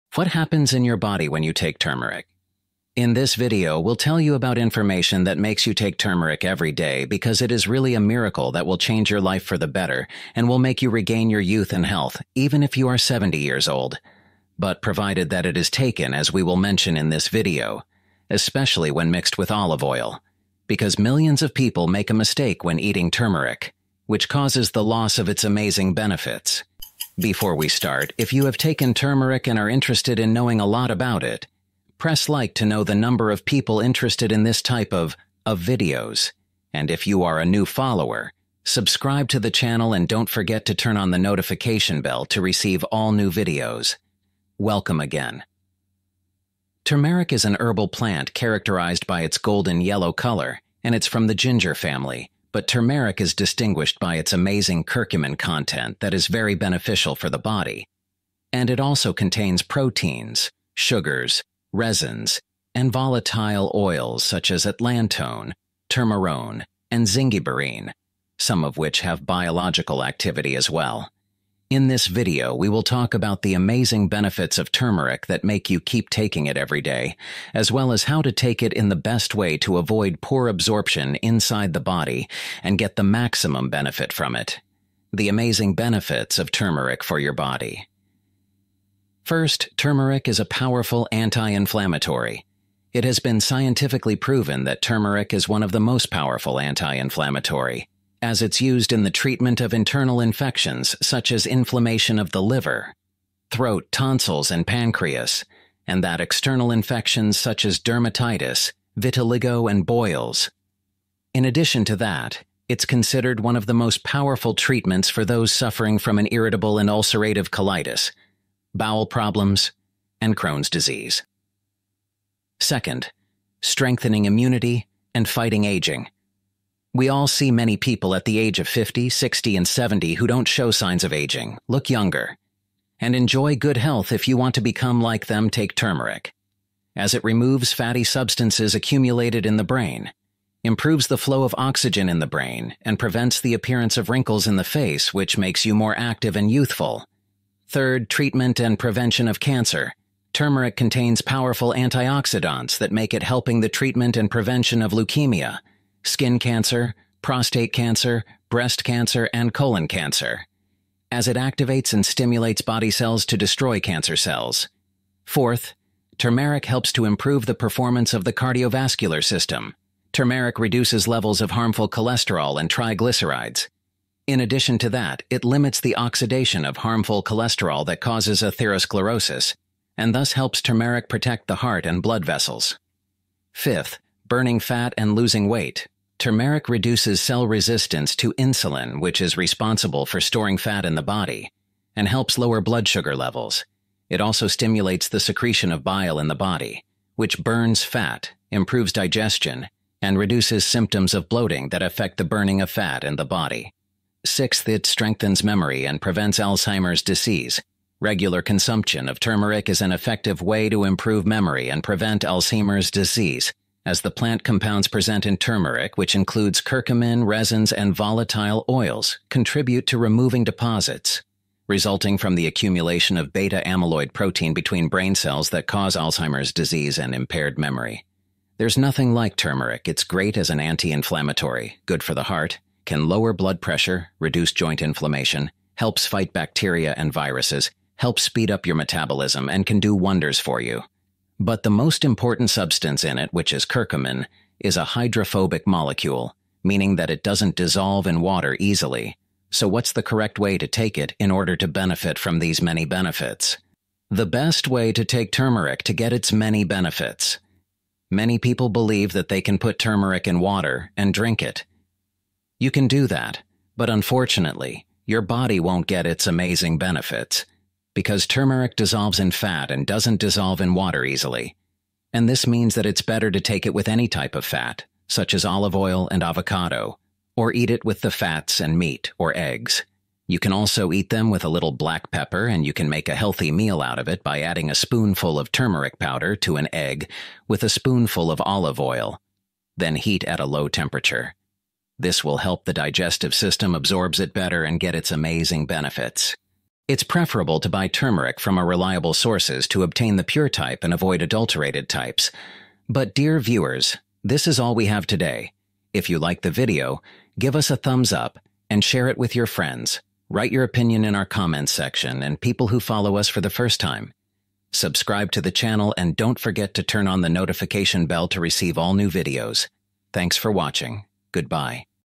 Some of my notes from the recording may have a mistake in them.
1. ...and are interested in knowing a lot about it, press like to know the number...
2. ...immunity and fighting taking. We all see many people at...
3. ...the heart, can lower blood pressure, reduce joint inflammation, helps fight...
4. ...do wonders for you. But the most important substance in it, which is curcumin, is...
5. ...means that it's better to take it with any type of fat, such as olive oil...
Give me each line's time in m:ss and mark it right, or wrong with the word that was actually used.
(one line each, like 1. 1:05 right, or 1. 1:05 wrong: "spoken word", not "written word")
1. 0:29 right
2. 2:04 wrong: "aging", not "taking"
3. 3:52 right
4. 3:59 right
5. 4:32 right.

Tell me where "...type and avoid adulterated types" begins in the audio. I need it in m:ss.
5:00.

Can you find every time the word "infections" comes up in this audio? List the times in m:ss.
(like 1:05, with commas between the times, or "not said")
1:40, 1:46.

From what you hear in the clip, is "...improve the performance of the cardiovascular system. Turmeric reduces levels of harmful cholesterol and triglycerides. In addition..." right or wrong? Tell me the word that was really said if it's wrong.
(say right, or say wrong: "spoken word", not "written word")
right.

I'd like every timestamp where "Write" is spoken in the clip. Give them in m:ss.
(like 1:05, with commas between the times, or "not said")
5:10.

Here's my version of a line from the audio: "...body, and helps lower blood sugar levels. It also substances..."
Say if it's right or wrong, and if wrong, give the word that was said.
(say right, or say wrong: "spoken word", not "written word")
wrong: "stimulates", not "substances".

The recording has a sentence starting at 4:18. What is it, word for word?
Many people believe that they can put turmeric in water and drink it.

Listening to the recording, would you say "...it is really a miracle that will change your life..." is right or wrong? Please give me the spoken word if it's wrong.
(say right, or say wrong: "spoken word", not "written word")
right.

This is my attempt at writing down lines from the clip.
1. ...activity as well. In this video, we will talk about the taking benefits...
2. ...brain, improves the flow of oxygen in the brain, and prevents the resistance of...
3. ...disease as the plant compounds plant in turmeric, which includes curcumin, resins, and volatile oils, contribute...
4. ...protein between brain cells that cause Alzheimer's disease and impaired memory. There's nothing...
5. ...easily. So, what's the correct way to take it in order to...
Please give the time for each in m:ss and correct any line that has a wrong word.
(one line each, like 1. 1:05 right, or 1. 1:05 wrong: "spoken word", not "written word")
1. 1:10 wrong: "amazing", not "taking"
2. 2:19 wrong: "appearance", not "resistance"
3. 3:32 wrong: "present", not "plant"
4. 3:44 right
5. 4:08 right.